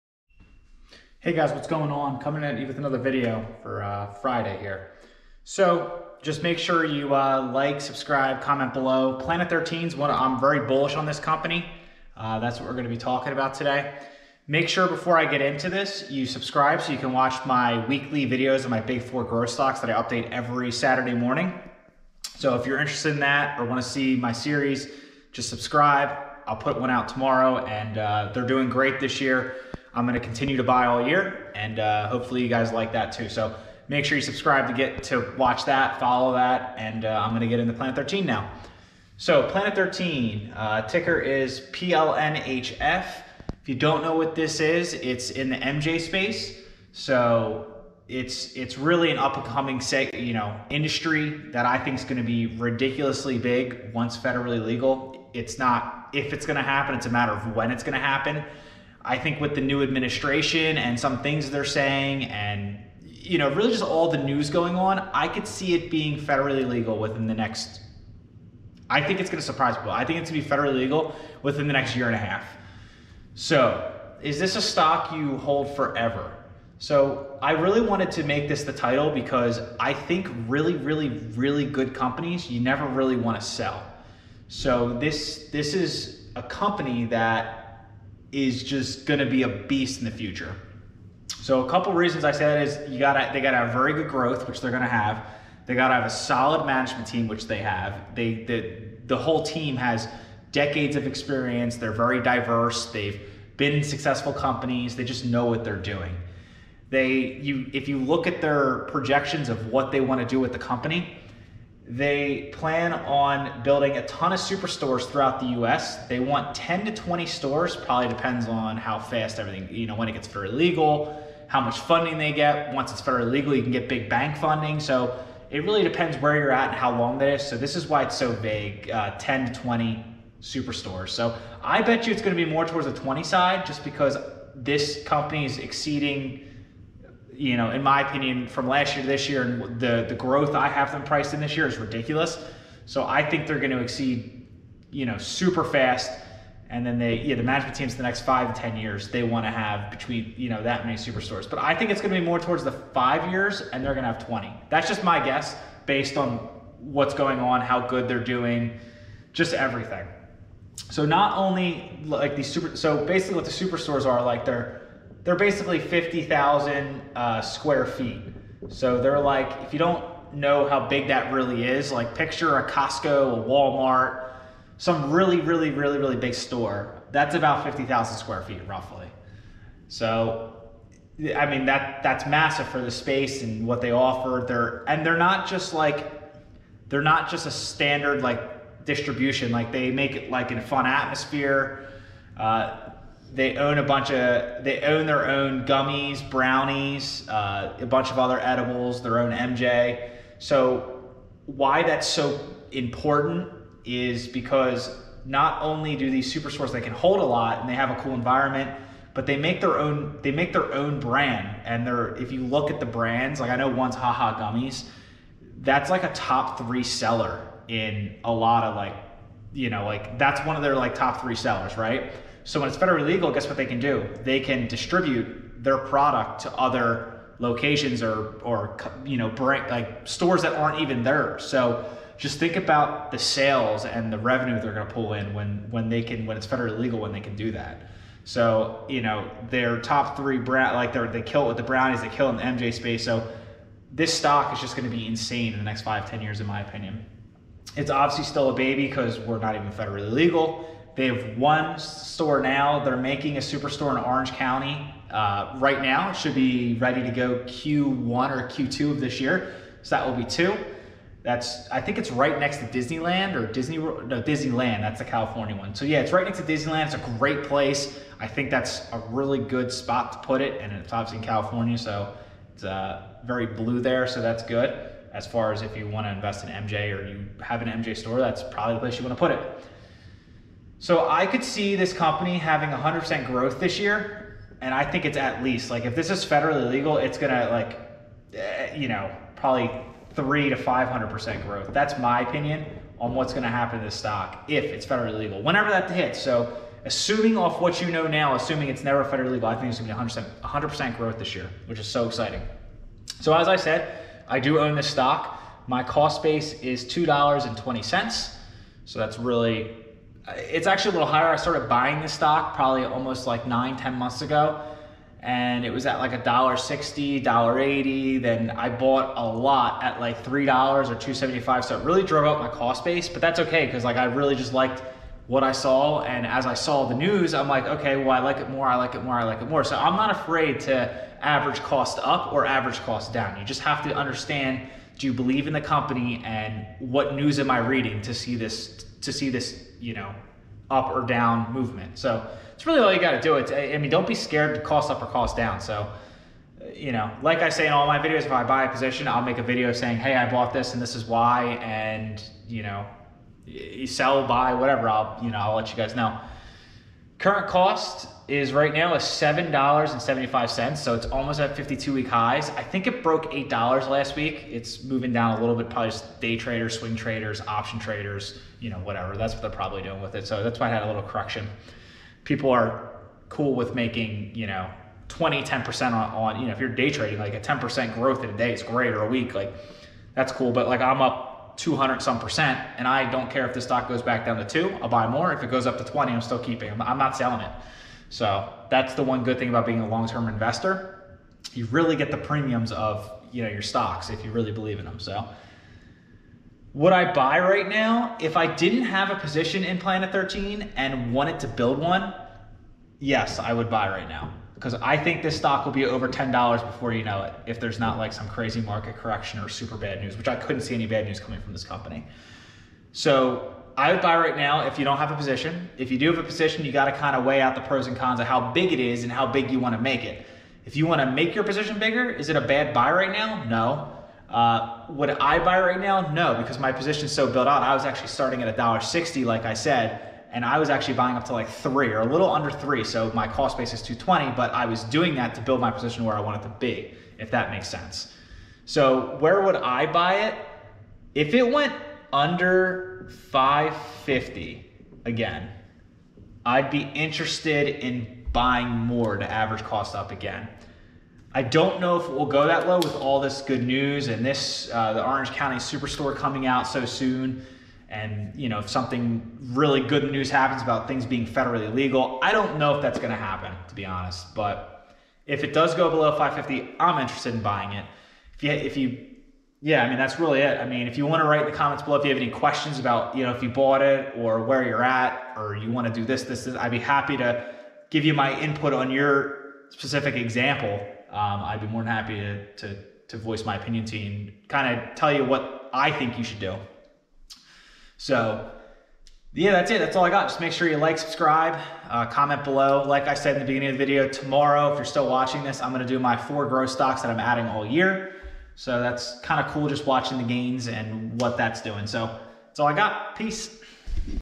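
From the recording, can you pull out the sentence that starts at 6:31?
You really get the premiums of you know your stocks if you really believe in them.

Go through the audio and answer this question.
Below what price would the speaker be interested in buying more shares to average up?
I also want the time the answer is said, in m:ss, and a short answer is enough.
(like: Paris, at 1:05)
$5.50, at 7:22.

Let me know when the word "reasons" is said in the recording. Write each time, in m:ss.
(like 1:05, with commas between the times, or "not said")
1:31.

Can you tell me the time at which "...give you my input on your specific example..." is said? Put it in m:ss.
7:57.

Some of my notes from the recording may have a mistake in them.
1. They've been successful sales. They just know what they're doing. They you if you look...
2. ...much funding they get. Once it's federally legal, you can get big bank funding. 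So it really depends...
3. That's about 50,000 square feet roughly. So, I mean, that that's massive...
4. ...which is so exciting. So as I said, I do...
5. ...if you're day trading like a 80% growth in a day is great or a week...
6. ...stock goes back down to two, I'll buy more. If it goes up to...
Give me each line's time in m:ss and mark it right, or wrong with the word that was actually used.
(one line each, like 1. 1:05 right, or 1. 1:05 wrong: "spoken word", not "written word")
1. 1:42 wrong: "companies", not "sales"
2. 2:01 right
3. 2:57 right
4. 5:01 right
5. 6:16 wrong: "10", not "80"
6. 6:23 right.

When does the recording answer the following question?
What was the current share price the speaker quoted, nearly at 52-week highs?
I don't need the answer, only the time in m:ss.
5:59.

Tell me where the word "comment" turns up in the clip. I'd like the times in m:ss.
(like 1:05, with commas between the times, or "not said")
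0:08, 7:51, 8:12.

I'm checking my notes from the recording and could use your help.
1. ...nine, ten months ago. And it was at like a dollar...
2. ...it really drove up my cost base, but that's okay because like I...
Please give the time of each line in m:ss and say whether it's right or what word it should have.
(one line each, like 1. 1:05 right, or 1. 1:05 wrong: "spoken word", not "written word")
1. 5:13 right
2. 5:21 right.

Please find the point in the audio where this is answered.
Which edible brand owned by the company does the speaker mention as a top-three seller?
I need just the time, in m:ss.
3:33.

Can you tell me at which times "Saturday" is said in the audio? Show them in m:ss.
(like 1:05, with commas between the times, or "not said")
0:20.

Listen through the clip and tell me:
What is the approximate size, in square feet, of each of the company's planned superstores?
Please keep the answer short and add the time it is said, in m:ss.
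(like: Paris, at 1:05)
50,000, at 2:45.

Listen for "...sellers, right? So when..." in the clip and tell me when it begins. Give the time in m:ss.
3:41.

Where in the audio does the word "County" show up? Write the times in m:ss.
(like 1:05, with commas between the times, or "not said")
4:14, 7:35.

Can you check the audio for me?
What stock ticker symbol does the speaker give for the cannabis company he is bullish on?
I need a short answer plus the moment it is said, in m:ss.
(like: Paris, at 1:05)
PLNHF, at 0:41.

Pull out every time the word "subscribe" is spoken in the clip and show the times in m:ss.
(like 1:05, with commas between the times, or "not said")
0:07, 0:16, 0:25, 0:34, 8:10.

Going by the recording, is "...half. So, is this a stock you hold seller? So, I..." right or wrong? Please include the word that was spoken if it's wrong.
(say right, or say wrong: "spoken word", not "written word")
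wrong: "forever", not "seller".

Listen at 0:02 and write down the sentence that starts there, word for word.
Coming at you with another video for uh, Friday here.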